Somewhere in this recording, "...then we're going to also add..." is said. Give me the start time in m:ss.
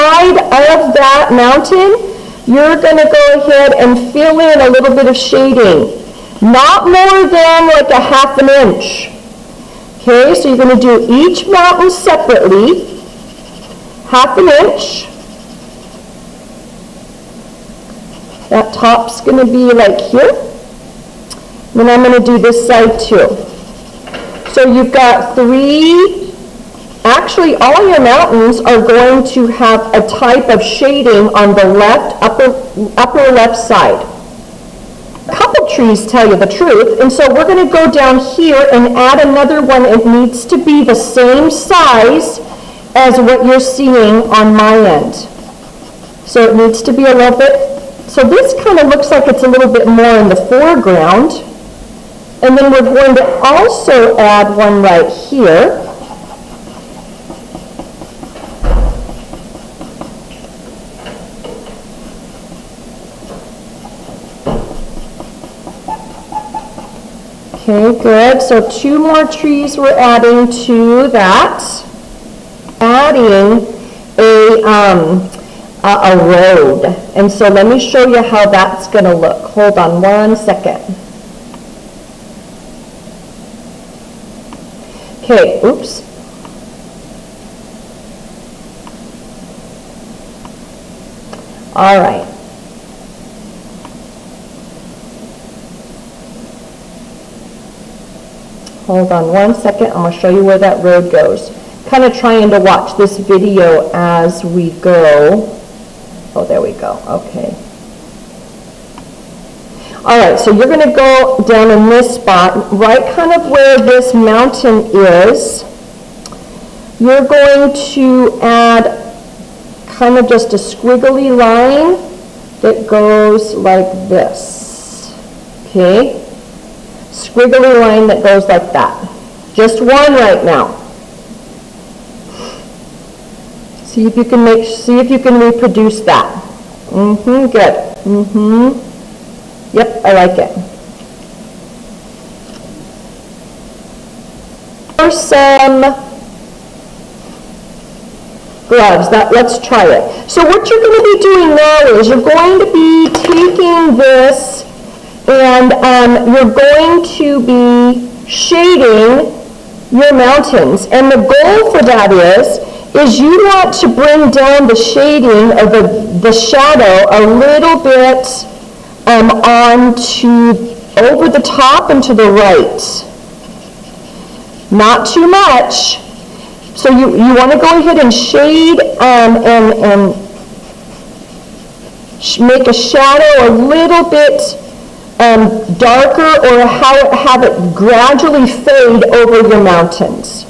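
0:52.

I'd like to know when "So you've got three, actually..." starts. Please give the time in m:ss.
0:24.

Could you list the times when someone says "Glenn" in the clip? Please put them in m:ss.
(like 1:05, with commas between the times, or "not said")
not said.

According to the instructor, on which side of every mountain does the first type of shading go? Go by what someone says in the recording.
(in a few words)
upper left side.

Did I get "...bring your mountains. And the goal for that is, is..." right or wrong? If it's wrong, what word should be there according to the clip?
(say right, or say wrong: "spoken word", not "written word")
wrong: "shading", not "bring".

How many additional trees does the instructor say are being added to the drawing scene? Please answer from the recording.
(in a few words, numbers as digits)
2.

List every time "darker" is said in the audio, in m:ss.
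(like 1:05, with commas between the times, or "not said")
3:05.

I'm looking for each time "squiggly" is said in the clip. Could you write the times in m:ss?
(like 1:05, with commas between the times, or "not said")
2:00, 2:07.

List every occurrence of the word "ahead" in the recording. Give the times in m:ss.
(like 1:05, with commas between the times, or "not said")
0:03, 2:57.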